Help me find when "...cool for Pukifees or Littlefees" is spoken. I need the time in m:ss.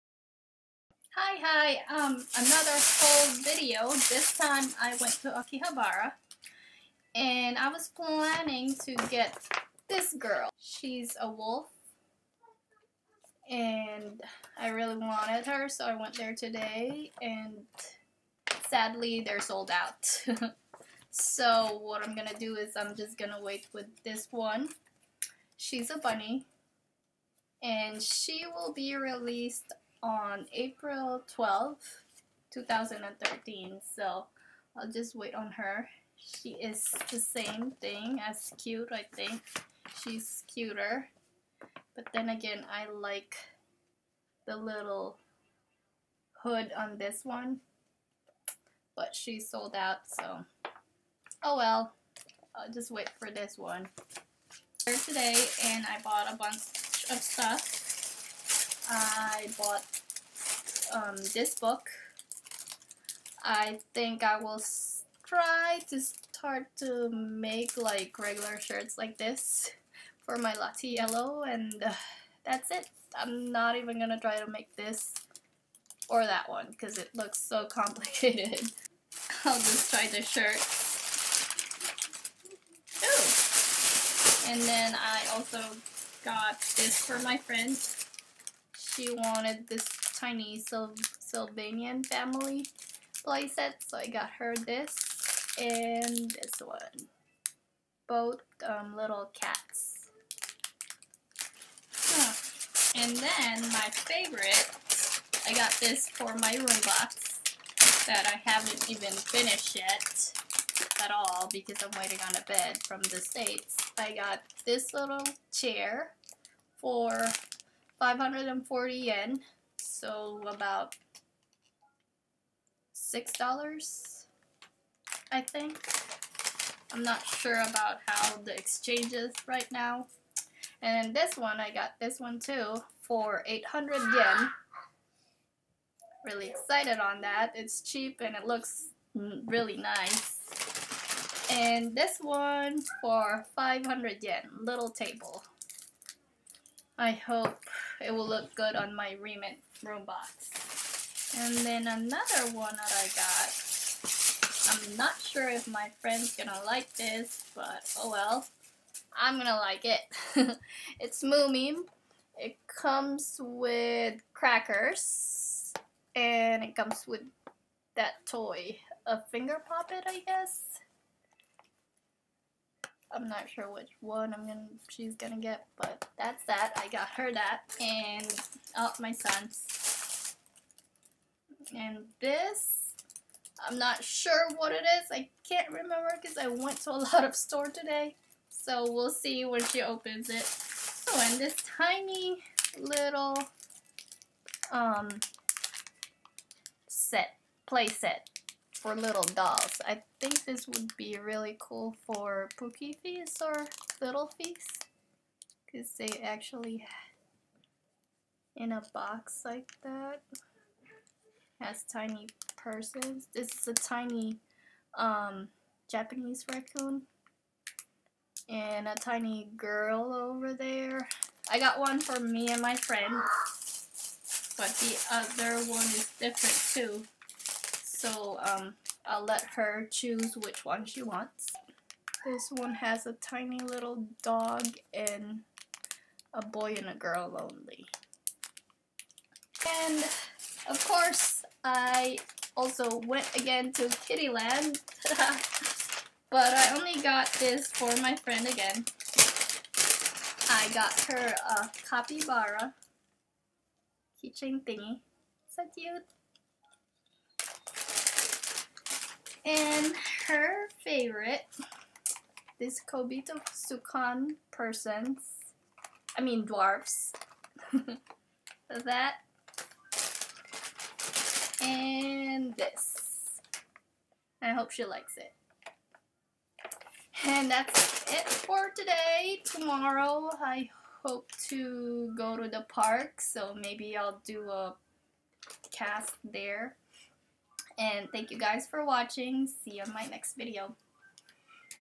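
3:21.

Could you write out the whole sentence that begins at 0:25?
She's a bunny and she will be released on April twelfth, two 2013.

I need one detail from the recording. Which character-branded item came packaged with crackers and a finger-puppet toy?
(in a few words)
Moomin.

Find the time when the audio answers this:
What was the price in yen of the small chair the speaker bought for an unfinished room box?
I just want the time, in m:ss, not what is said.
1:58.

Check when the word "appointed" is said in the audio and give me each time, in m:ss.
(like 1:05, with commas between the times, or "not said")
not said.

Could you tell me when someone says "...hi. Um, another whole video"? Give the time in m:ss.
0:01.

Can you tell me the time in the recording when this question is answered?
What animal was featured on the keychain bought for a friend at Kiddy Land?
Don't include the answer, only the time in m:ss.
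4:11.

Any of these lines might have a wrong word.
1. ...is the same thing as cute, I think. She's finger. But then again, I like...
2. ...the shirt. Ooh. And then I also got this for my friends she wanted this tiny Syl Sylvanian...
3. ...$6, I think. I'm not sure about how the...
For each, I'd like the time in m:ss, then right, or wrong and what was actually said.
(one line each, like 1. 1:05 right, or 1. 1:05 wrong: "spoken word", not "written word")
1. 0:36 wrong: "cuter", not "finger"
2. 1:20 right
3. 2:02 right.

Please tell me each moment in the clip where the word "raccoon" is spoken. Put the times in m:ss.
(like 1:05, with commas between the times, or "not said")
3:36.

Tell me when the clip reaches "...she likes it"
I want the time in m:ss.
4:34.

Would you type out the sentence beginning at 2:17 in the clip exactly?
It's cheap and it looks really nice.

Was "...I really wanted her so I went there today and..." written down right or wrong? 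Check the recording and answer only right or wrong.
right.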